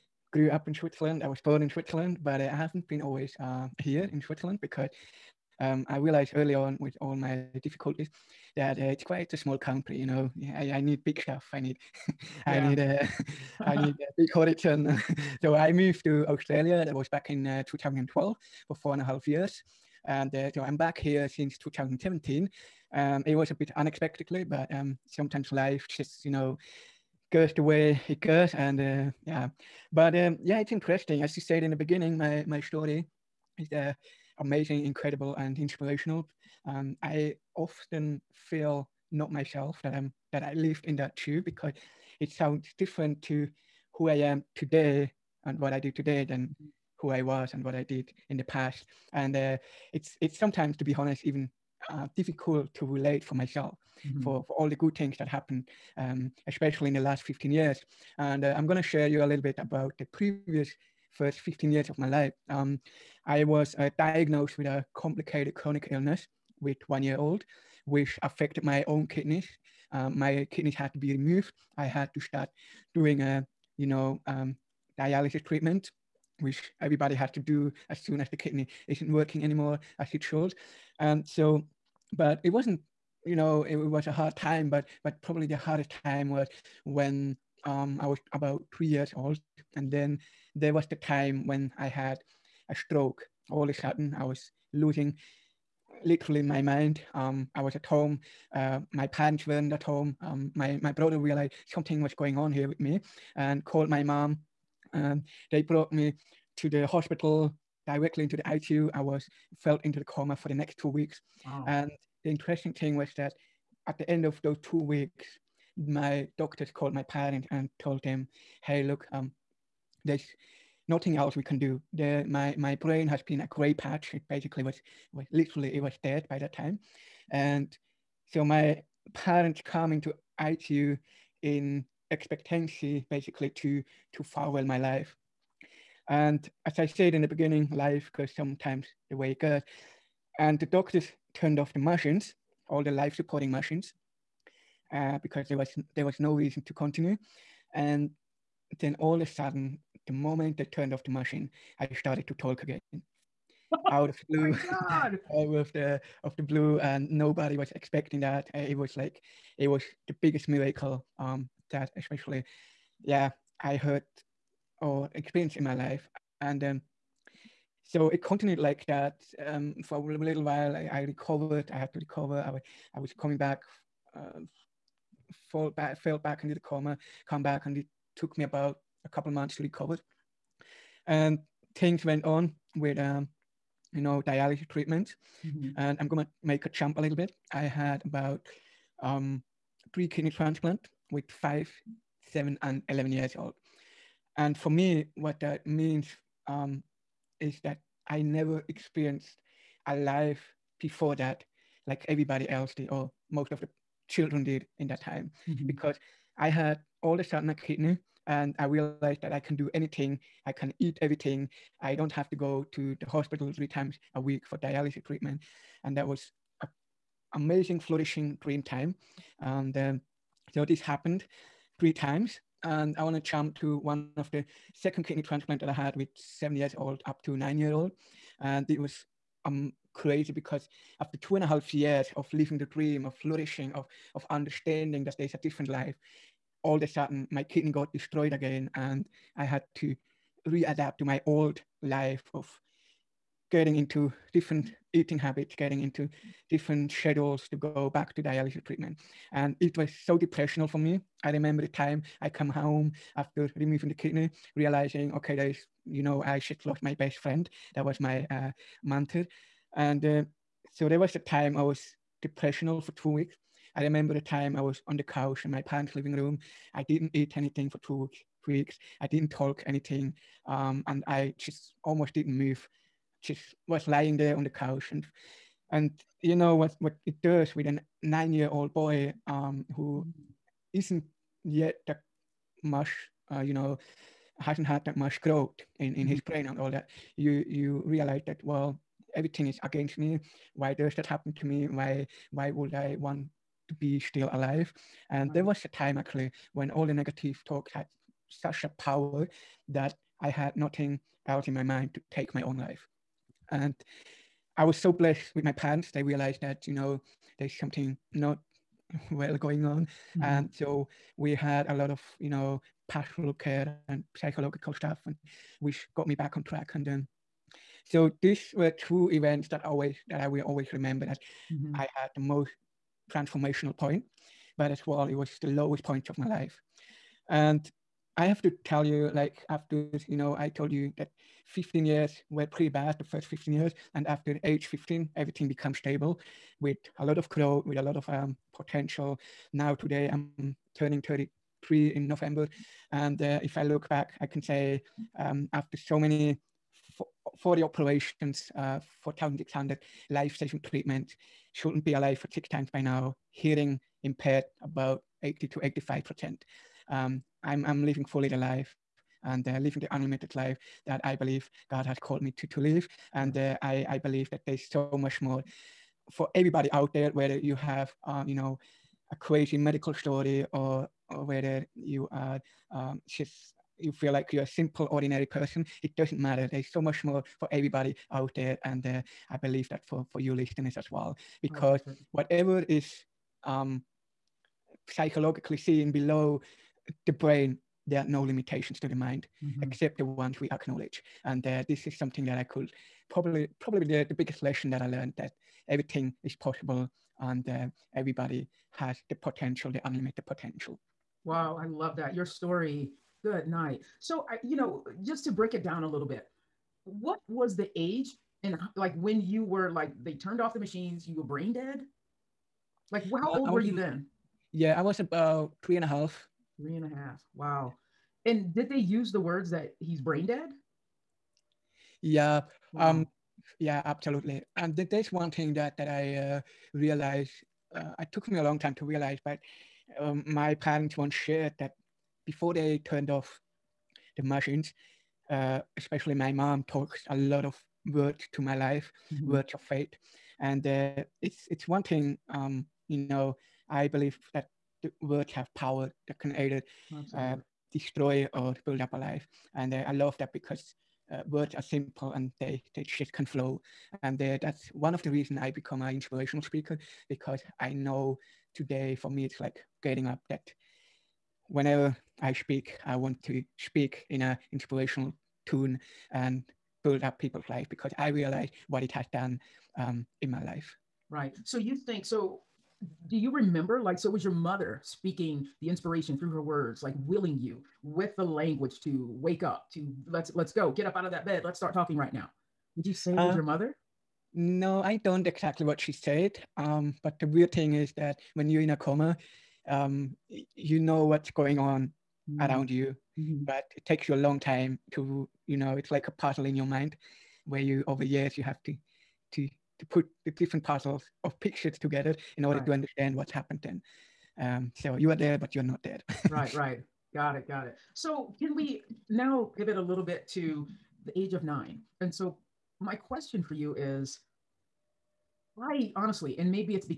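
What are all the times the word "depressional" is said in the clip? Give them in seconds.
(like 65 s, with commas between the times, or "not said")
250 s, 262 s.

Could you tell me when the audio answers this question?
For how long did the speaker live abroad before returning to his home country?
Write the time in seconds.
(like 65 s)
18 s.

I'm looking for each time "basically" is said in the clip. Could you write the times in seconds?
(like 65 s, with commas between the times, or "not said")
124 s, 133 s.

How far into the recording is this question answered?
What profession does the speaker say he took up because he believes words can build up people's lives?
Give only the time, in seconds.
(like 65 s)
455 s.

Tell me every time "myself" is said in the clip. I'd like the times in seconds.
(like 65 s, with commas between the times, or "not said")
39 s, 53 s.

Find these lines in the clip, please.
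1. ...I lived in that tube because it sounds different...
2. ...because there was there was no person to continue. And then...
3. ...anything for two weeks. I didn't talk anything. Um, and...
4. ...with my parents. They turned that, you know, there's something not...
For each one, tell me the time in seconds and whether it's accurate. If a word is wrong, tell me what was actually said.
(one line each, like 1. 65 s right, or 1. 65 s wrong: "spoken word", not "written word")
1. 40 s right
2. 145 s wrong: "reason", not "person"
3. 267 s right
4. 305 s wrong: "realized", not "turned".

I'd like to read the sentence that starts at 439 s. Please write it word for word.
words of faith, and uh, it's it's one thing.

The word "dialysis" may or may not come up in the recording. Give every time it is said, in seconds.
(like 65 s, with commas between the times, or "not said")
74 s, 184 s, 214 s, 248 s.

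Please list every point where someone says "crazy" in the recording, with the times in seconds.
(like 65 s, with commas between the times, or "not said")
229 s, 369 s.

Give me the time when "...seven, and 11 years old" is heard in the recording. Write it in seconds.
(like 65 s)
192 s.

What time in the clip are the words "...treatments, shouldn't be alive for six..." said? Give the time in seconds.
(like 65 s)
350 s.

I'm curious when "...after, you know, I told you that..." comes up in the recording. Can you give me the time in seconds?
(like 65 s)
329 s.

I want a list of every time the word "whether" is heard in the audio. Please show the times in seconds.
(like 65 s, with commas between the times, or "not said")
367 s, 371 s.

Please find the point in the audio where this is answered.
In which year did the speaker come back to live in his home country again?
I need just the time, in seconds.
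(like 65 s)
21 s.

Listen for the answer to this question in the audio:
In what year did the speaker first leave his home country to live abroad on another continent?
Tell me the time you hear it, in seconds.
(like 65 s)
17 s.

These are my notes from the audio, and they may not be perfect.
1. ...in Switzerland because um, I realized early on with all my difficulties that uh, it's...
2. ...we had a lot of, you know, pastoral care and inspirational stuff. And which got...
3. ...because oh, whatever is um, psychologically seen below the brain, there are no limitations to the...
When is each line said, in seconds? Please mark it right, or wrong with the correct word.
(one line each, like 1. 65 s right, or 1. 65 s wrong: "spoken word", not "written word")
1. 4 s right
2. 311 s wrong: "psychological", not "inspirational"
3. 381 s right.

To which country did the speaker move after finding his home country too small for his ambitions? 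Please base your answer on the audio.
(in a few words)
Australia.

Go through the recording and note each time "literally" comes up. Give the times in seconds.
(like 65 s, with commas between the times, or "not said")
96 s, 125 s.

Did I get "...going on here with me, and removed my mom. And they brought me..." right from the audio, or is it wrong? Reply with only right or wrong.
wrong.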